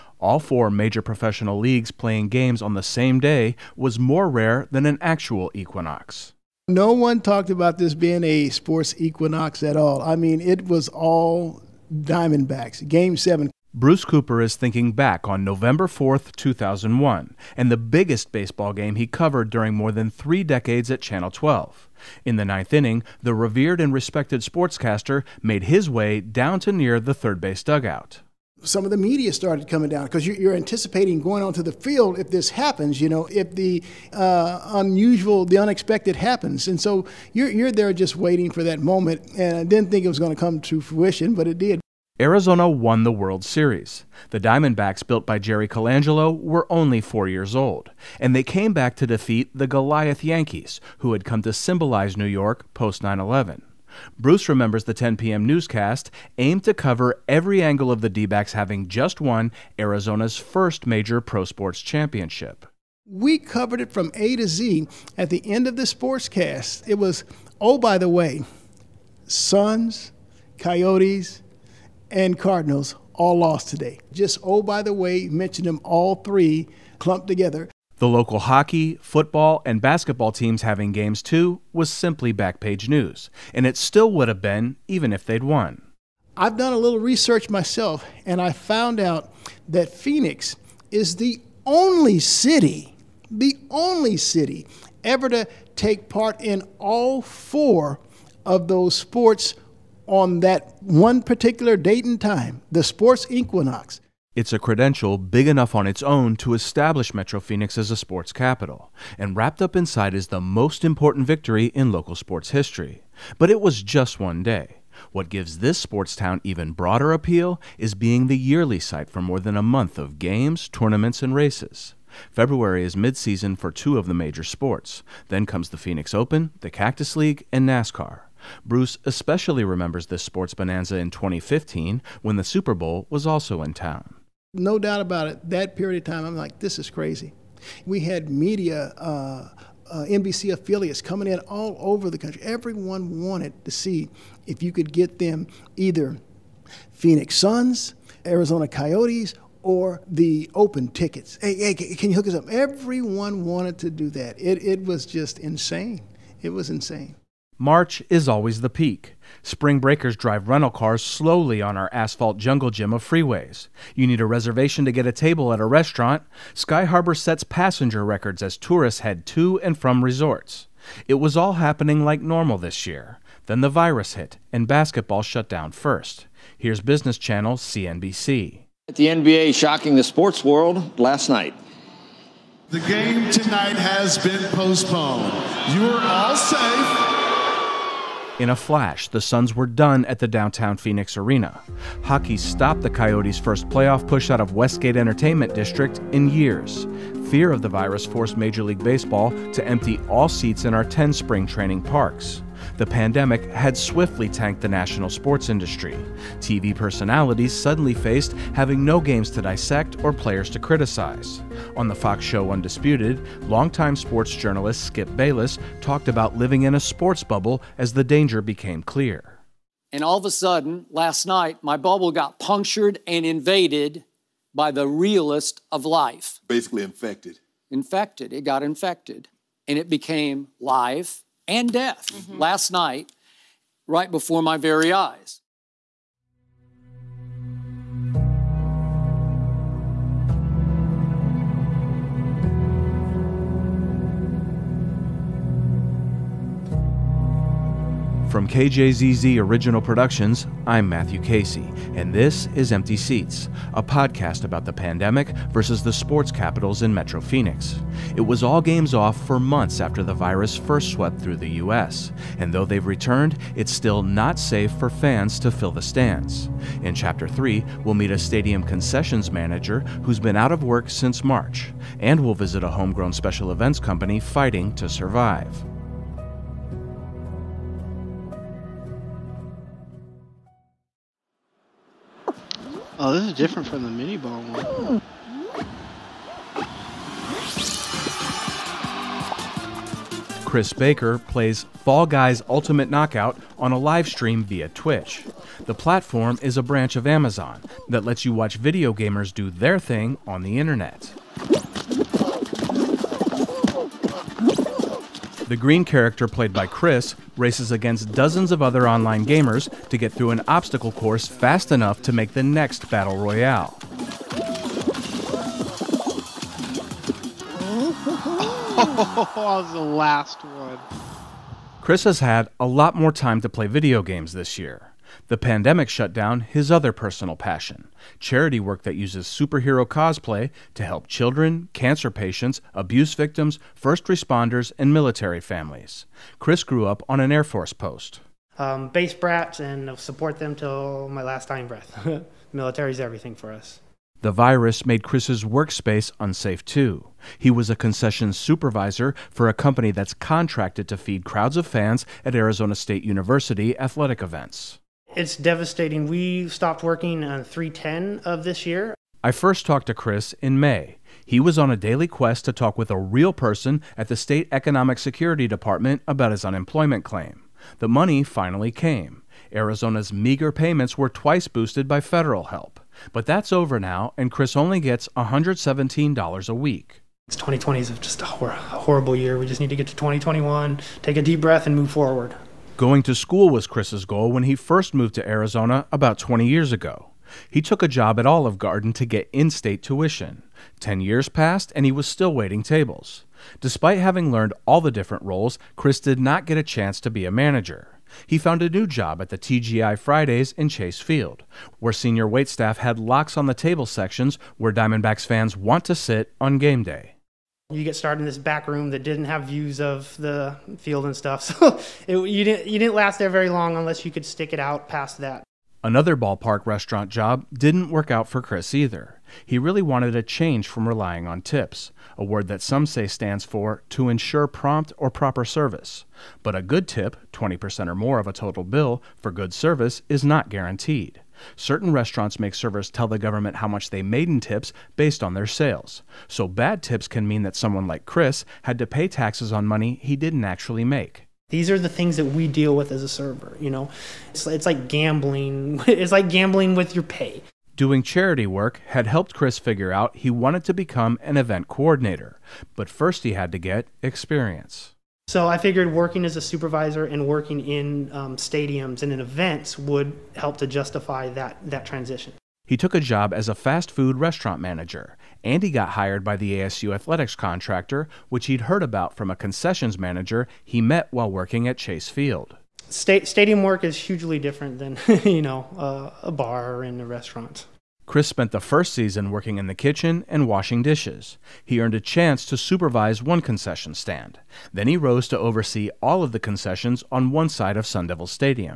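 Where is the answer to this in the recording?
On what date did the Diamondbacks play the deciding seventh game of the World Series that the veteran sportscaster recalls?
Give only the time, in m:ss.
0:15.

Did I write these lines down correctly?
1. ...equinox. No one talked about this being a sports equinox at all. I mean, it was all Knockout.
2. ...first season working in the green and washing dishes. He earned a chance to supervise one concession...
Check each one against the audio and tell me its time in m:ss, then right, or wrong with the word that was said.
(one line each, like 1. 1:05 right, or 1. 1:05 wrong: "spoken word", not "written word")
1. 0:05 wrong: "Diamondbacks", not "Knockout"
2. 7:58 wrong: "kitchen", not "green".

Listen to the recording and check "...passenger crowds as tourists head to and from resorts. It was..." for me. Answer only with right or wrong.
wrong.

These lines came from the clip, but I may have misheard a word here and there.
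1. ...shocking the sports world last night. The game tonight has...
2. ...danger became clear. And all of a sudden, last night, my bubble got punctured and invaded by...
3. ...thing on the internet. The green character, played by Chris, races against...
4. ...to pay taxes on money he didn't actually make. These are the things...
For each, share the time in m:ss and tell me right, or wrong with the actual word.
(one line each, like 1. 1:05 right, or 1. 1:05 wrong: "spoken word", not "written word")
1. 2:59 right
2. 3:38 right
3. 4:59 right
4. 7:18 right.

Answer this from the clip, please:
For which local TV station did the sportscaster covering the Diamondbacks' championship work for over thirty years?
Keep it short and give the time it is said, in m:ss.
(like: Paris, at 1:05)
Channel 12, at 0:20.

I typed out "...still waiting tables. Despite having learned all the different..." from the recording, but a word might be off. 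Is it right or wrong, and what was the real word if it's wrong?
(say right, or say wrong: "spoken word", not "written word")
right.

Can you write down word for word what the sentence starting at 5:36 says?
Chris grew up on an Air Force post.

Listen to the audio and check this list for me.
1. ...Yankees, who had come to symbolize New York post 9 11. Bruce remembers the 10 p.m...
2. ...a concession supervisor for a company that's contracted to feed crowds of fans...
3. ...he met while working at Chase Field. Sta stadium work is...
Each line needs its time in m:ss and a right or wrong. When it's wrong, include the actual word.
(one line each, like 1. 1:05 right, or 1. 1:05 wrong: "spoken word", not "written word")
1. 0:50 right
2. 5:47 right
3. 7:50 right.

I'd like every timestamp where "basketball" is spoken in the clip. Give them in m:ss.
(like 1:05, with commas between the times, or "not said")
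1:19, 2:54.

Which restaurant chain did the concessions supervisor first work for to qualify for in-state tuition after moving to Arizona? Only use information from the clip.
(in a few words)
Olive Garden.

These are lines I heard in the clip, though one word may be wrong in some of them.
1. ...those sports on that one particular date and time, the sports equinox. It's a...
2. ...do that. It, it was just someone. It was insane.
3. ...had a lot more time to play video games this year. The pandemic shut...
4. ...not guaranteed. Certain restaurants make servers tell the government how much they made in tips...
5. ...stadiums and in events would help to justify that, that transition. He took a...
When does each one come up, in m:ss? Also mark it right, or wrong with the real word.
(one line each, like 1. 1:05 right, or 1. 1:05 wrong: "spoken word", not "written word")
1. 1:38 right
2. 2:33 wrong: "insane", not "someone"
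3. 5:22 right
4. 7:10 right
5. 7:38 right.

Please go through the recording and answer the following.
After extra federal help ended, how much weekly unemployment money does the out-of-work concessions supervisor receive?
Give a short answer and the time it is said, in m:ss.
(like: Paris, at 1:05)
$117, at 6:15.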